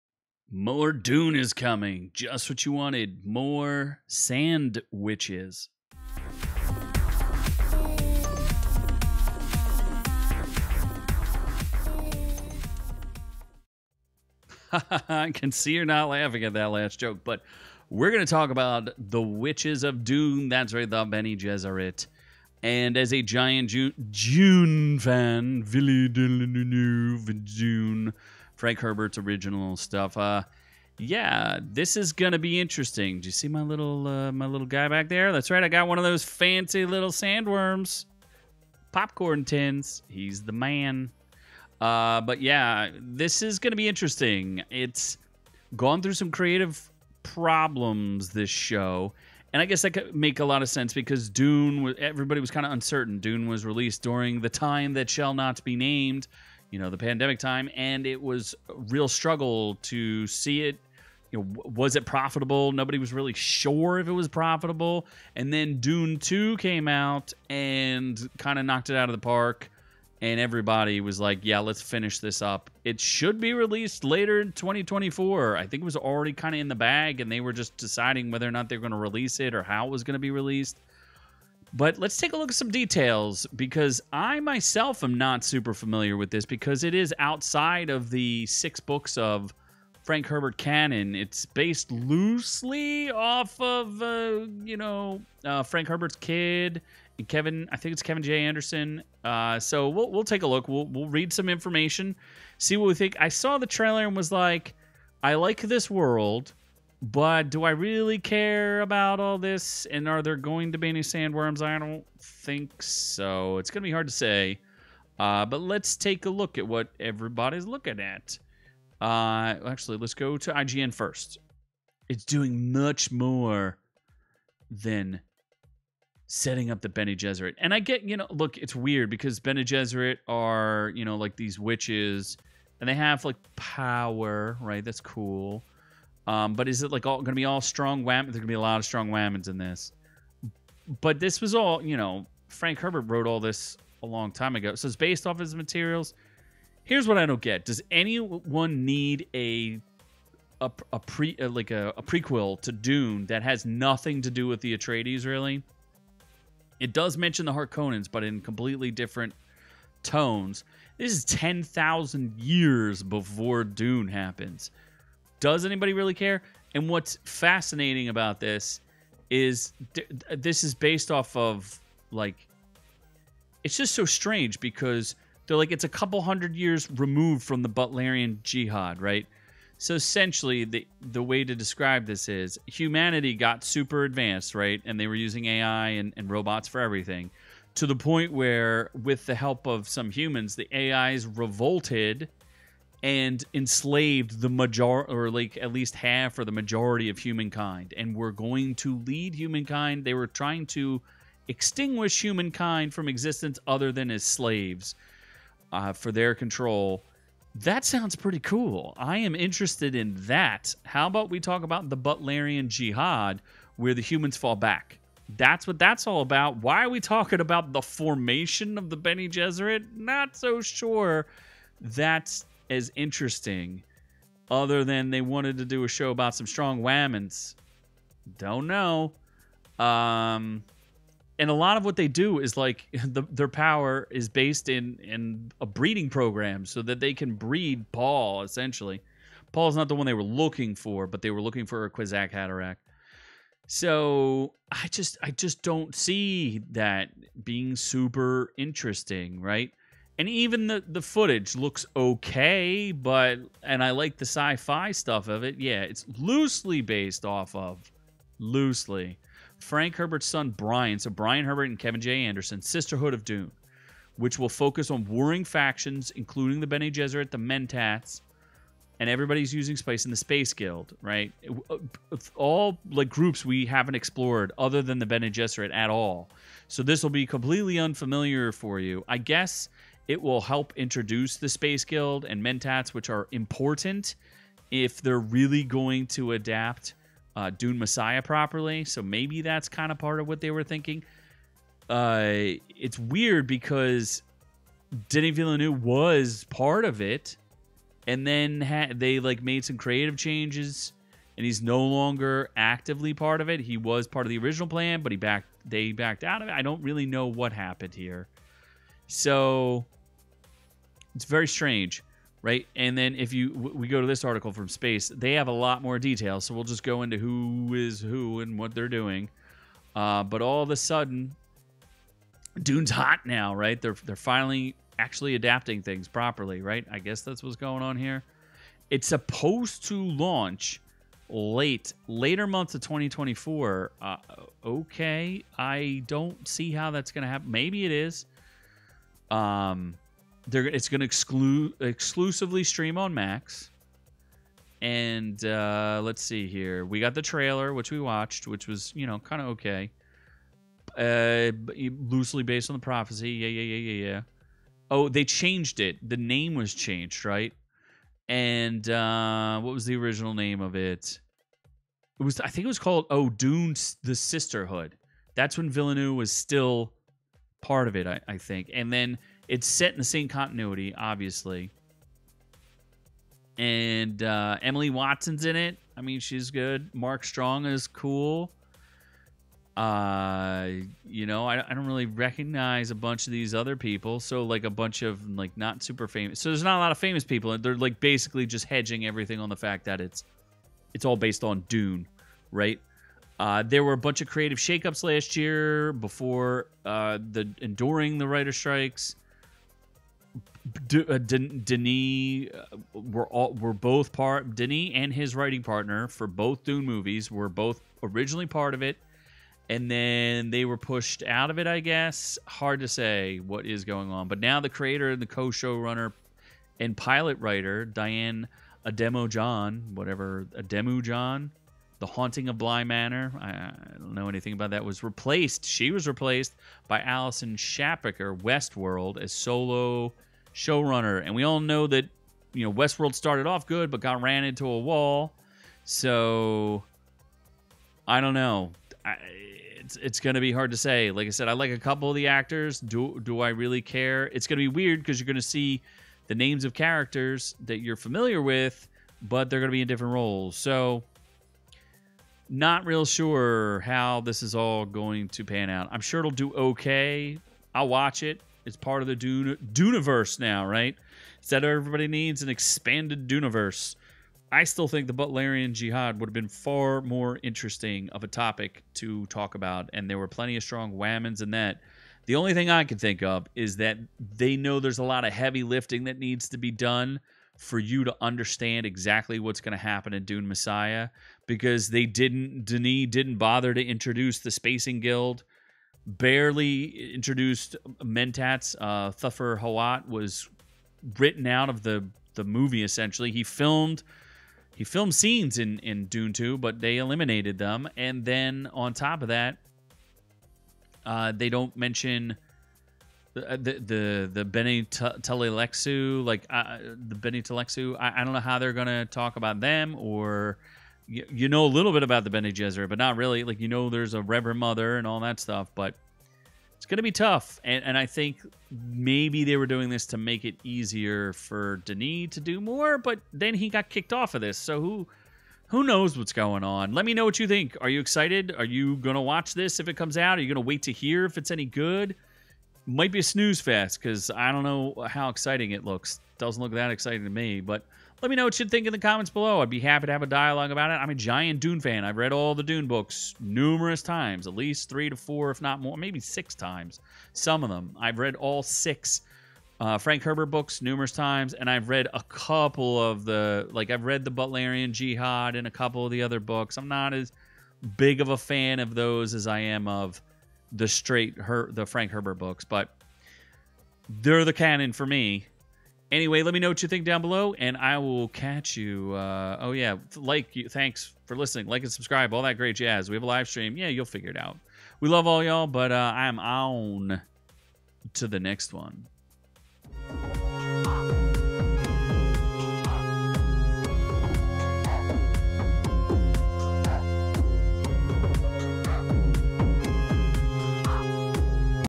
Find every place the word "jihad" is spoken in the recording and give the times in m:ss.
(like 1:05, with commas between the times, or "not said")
2:58, 3:32, 7:45, 9:14.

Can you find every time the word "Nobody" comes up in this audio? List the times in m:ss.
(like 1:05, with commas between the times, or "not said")
1:02.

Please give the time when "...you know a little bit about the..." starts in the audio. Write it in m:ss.
8:31.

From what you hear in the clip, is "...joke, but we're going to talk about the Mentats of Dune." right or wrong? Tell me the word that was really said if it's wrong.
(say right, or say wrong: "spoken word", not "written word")
wrong: "Witches", not "Mentats".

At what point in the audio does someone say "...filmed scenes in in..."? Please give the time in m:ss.
8:14.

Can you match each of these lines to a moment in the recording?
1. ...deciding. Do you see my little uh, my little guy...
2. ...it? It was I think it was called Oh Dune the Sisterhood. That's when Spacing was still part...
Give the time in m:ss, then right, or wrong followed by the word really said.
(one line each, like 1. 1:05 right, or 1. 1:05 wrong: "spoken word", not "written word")
1. 0:32 wrong: "interesting", not "deciding"
2. 6:00 wrong: "Villeneuve", not "Spacing".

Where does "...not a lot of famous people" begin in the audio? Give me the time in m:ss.
6:26.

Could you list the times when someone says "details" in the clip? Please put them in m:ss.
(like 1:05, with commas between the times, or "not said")
1:22, 5:15.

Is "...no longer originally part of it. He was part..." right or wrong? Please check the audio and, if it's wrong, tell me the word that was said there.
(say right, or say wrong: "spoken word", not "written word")
wrong: "actively", not "originally".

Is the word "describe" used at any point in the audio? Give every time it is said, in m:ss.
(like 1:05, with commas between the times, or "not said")
3:01.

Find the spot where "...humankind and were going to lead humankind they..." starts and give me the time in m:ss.
3:17.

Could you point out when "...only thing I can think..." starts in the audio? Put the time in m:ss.
7:52.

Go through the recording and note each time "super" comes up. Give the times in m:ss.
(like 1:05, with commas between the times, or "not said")
1:25, 3:03, 4:07, 6:25.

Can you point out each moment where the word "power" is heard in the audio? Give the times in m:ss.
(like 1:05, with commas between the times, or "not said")
2:13, 3:53.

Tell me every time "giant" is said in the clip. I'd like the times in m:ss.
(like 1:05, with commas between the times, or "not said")
0:23, 9:01.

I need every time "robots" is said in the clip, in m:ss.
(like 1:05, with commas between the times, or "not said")
3:06.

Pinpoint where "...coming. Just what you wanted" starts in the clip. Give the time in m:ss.
0:01.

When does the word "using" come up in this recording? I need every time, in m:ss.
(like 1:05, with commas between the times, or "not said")
3:05, 4:29.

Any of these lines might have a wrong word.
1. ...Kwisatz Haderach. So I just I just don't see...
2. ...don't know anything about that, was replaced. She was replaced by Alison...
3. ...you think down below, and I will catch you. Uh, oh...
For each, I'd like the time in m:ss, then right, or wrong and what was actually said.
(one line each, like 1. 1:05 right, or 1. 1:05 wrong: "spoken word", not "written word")
1. 4:01 right
2. 7:03 right
3. 9:26 right.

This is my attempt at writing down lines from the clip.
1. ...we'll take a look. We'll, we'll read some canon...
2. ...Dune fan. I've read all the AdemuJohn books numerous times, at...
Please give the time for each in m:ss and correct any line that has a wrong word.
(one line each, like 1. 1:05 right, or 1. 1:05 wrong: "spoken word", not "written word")
1. 1:40 wrong: "information", not "canon"
2. 9:01 wrong: "Dune", not "AdemuJohn".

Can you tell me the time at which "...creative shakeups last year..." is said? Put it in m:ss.
6:34.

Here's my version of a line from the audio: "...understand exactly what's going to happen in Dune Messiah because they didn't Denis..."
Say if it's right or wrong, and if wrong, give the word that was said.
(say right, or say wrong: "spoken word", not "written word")
right.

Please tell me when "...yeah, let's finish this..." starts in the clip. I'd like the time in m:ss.
1:11.